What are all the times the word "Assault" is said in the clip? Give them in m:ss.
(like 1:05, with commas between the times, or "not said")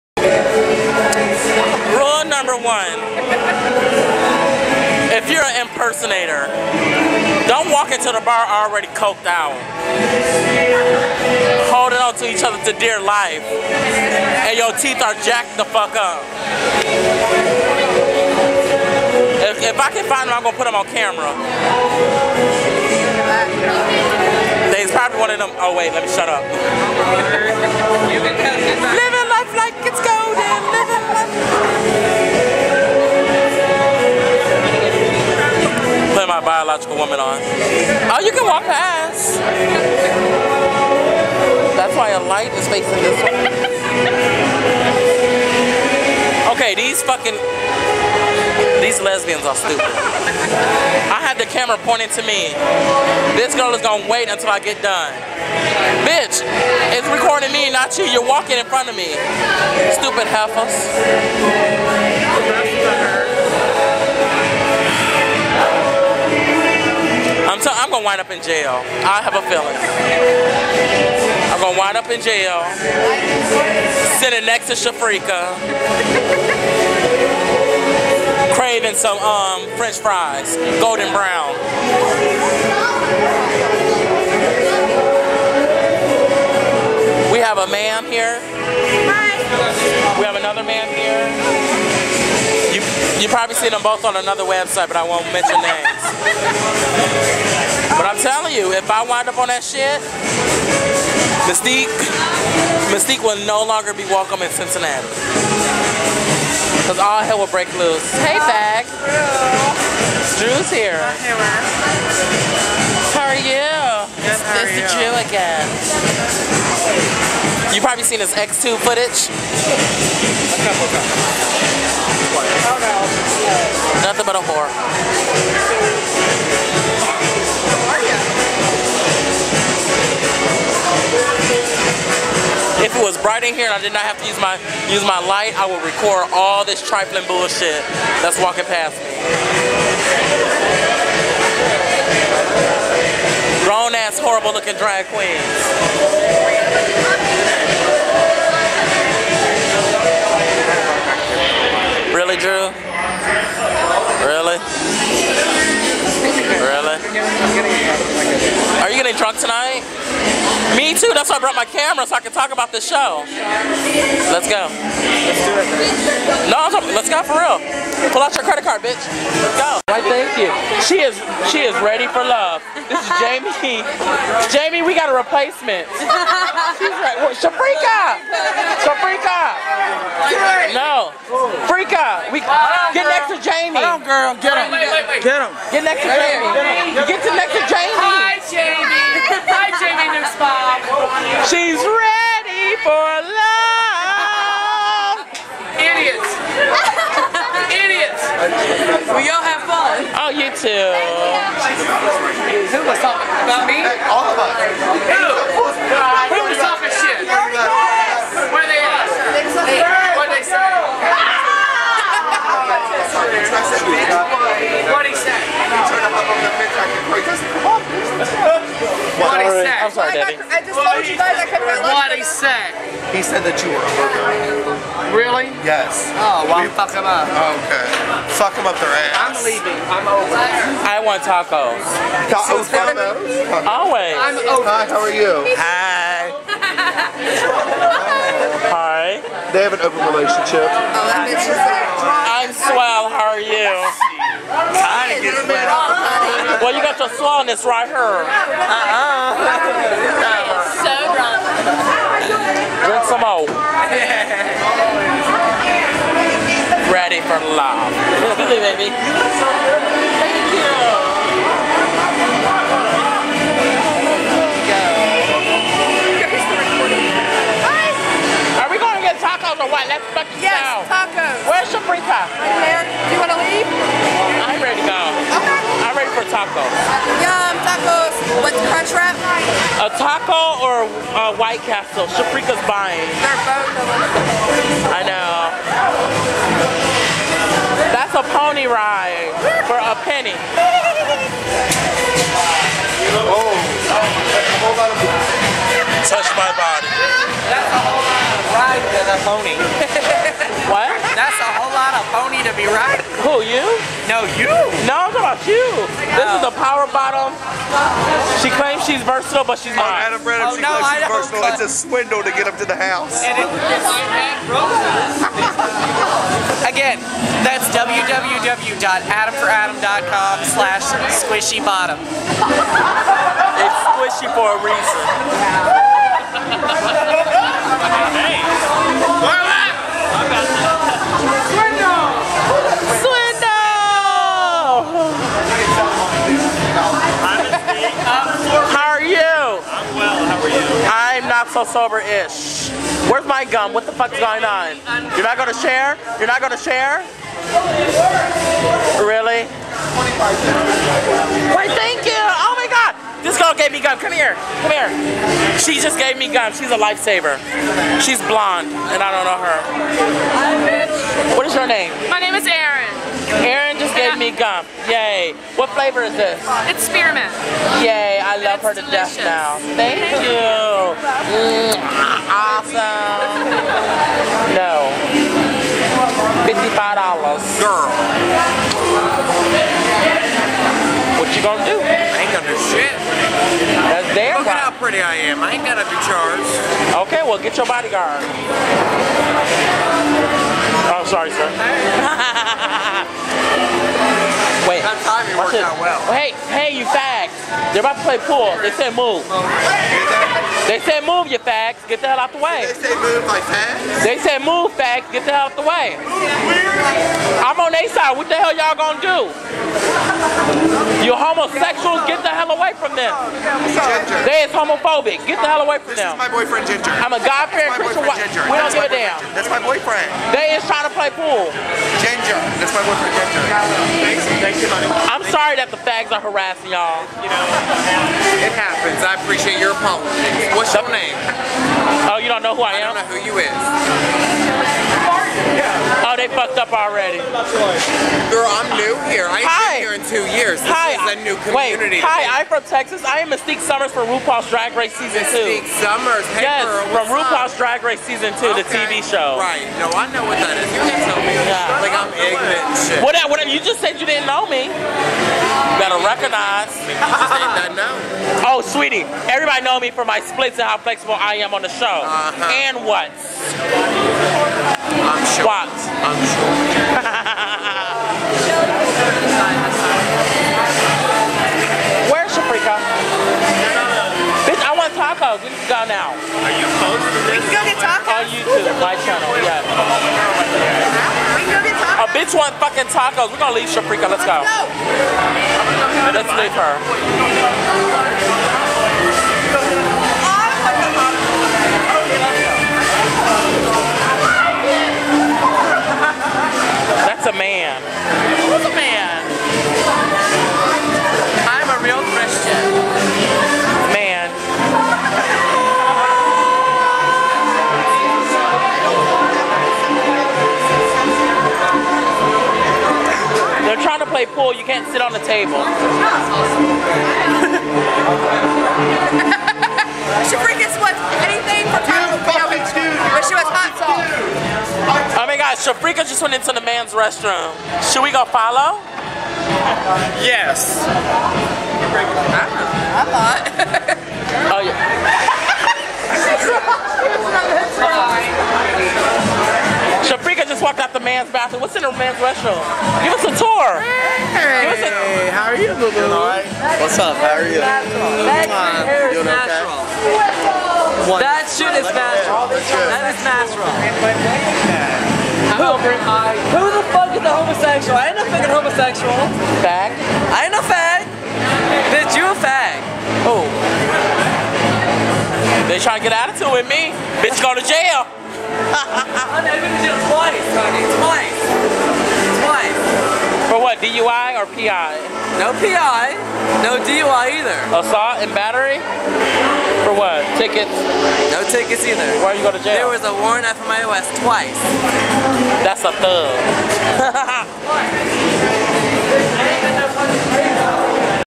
9:37.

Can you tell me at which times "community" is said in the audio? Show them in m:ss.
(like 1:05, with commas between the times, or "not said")
7:21.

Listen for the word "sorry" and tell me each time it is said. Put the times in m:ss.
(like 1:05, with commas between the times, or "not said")
6:31, 7:05.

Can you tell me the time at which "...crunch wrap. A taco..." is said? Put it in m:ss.
4:38.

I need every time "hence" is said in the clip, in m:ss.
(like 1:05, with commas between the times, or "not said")
not said.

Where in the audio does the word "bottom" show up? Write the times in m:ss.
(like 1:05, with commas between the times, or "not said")
5:06, 5:21.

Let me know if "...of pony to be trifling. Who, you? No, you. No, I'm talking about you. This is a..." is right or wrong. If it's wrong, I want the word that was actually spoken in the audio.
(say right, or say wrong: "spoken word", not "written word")
wrong: "riding", not "trifling".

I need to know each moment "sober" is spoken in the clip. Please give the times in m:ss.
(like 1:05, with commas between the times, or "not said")
5:41.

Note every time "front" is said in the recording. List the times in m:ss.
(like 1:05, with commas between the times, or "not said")
0:58.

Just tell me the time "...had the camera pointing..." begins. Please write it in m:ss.
0:51.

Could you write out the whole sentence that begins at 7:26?
Hey, yes, girl, from RuPaul's up?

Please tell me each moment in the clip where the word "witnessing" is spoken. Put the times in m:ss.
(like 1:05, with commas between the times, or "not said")
not said.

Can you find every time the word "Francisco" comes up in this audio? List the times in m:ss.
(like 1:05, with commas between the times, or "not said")
not said.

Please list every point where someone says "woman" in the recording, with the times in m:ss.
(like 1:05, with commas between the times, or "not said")
0:36.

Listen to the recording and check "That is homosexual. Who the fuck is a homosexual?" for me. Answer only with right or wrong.
wrong.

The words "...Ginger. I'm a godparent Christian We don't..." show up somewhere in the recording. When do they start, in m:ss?
6:56.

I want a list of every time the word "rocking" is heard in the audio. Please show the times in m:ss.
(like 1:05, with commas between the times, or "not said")
not said.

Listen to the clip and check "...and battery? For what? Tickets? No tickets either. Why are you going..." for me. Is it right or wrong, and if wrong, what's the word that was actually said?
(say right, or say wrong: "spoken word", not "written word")
right.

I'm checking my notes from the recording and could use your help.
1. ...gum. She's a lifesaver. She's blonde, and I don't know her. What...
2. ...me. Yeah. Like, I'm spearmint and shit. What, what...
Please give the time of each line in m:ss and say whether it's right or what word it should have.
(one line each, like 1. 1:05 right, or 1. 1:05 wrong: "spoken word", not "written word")
1. 5:56 right
2. 7:31 wrong: "ignorant", not "spearmint".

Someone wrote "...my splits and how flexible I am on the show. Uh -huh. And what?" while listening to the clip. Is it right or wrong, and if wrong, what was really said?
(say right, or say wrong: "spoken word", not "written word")
right.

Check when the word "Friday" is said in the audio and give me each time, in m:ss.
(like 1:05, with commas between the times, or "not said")
not said.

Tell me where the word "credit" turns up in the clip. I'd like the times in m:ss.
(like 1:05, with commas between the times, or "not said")
2:48.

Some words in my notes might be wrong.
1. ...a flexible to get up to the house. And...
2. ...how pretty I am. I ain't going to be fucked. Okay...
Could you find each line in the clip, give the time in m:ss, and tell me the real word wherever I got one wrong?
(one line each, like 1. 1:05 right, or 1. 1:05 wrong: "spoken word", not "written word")
1. 5:11 wrong: "swindle", not "flexible"
2. 6:24 wrong: "charged", not "fucked".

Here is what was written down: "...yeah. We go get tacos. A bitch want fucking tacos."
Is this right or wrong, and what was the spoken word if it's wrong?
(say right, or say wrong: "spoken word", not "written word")
right.